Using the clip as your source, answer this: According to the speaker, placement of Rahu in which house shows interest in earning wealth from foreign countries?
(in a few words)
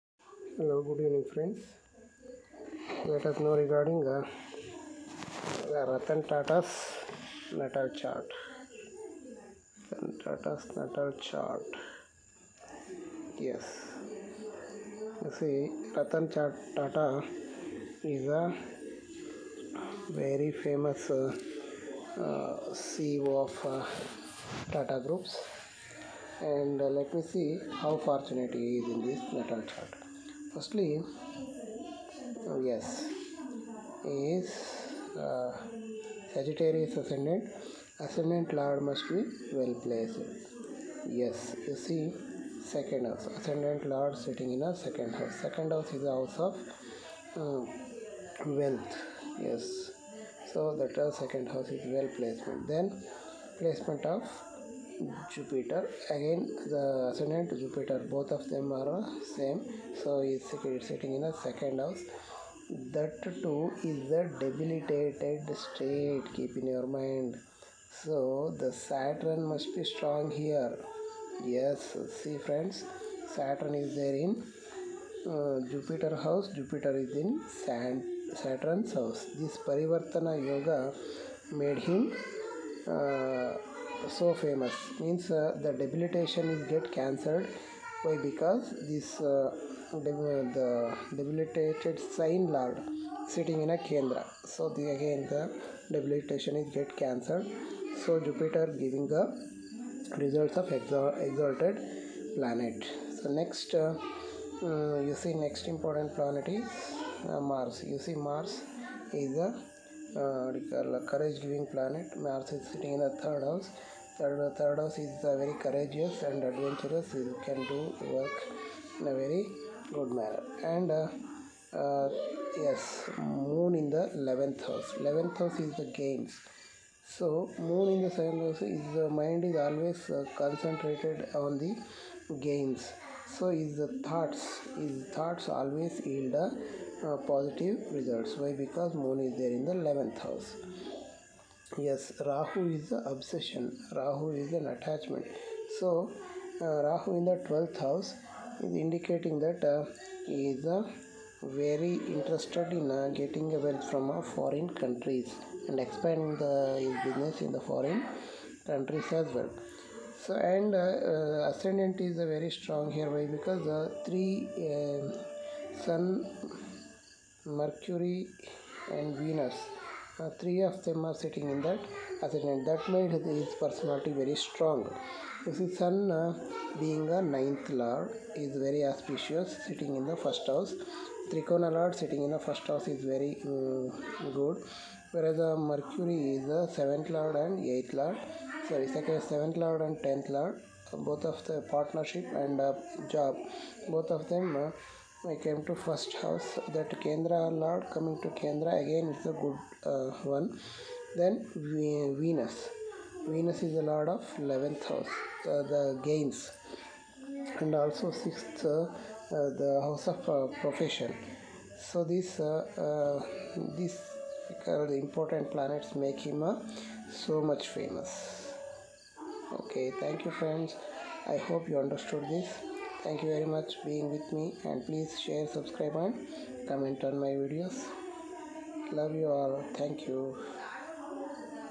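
Twelfth house.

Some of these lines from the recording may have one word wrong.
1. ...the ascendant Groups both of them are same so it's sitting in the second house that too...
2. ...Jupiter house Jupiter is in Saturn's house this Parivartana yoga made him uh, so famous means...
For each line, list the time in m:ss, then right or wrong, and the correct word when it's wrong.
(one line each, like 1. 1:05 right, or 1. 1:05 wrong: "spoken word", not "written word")
1. 0:56 wrong: "Jupiter", not "Groups"
2. 1:15 right.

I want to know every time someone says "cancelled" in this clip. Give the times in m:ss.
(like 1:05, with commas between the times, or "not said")
1:26, 1:36.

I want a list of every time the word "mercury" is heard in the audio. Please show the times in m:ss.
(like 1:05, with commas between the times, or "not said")
2:47, 3:05.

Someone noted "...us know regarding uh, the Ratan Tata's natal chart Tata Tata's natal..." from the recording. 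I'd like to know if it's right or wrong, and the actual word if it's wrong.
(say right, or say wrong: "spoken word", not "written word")
wrong: "Ratan", not "Tata".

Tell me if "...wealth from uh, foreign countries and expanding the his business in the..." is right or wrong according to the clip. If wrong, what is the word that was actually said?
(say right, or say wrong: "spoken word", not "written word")
right.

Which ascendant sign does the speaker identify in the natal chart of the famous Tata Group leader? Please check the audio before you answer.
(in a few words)
Sagittarius.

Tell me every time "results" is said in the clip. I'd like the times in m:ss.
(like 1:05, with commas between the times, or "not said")
1:40, 2:17.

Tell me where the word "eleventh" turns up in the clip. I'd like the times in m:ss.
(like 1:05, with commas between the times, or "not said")
2:19.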